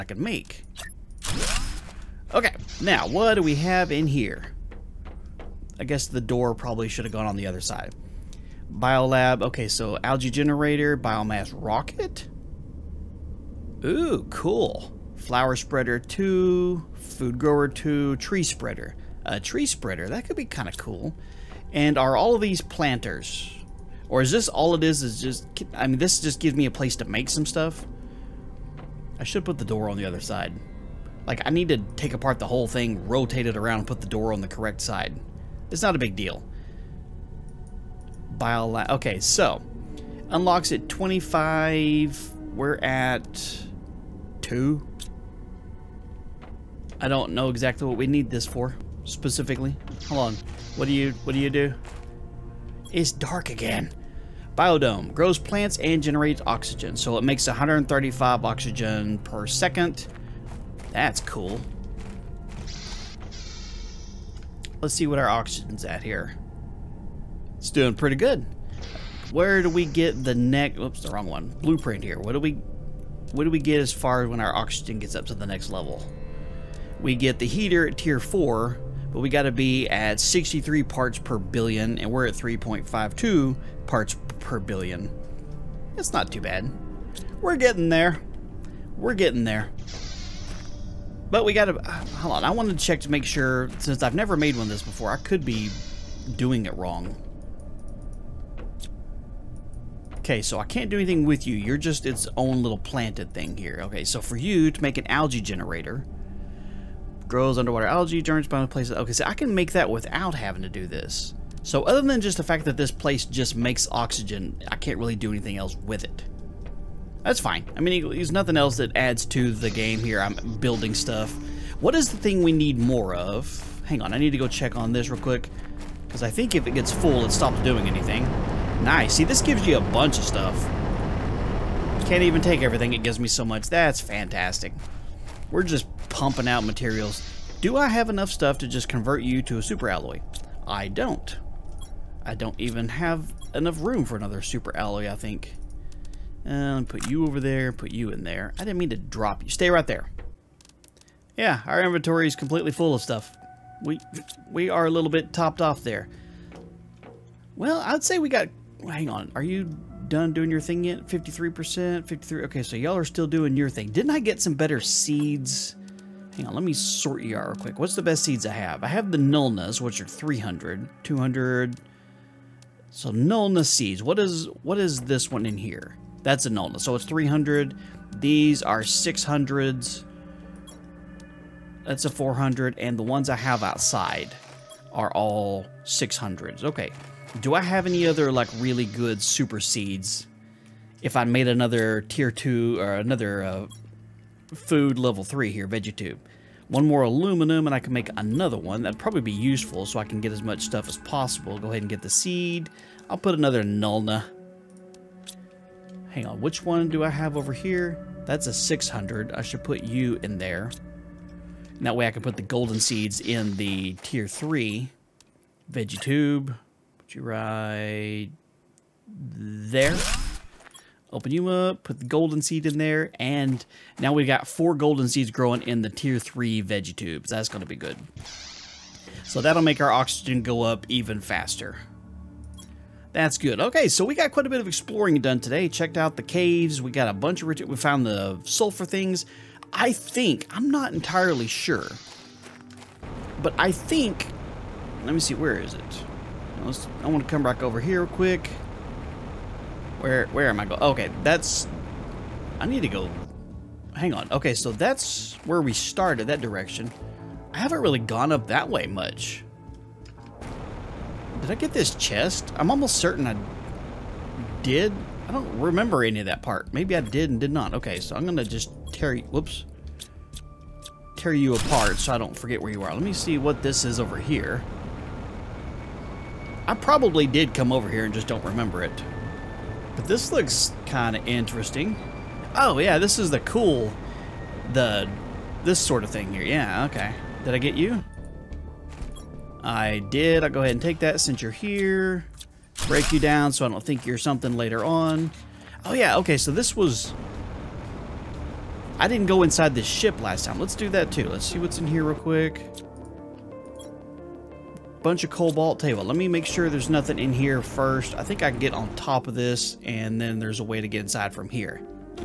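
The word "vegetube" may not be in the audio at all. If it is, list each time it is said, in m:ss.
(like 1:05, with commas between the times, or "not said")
3:15, 3:35, 3:46.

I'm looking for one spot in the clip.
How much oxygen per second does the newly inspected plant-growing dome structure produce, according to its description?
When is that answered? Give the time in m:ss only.
0:57.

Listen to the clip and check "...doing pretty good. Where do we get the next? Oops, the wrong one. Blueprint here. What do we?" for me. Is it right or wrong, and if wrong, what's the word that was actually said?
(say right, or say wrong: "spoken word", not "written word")
right.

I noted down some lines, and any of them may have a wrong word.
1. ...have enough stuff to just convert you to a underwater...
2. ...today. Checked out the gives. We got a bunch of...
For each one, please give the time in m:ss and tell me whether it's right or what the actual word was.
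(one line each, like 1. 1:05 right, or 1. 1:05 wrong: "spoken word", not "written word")
1. 2:17 wrong: "super", not "underwater"
2. 3:55 wrong: "caves", not "gives".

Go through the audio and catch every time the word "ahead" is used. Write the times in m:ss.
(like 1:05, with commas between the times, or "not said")
3:21, 4:50.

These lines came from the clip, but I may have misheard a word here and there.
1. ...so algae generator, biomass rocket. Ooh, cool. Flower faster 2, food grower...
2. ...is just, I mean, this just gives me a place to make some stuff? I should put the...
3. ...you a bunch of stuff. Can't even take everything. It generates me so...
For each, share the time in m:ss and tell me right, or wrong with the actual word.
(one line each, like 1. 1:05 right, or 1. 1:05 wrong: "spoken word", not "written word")
1. 0:09 wrong: "spreader", not "faster"
2. 0:25 right
3. 2:09 wrong: "gives", not "generates".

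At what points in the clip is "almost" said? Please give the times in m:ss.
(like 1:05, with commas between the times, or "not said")
4:22.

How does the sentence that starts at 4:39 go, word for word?
But this looks kind of interesting.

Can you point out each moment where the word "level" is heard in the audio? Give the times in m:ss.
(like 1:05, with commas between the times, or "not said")
1:15, 3:14.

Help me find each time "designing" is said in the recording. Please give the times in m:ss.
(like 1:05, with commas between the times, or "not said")
not said.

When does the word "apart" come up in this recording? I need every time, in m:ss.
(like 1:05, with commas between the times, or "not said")
0:32, 4:31.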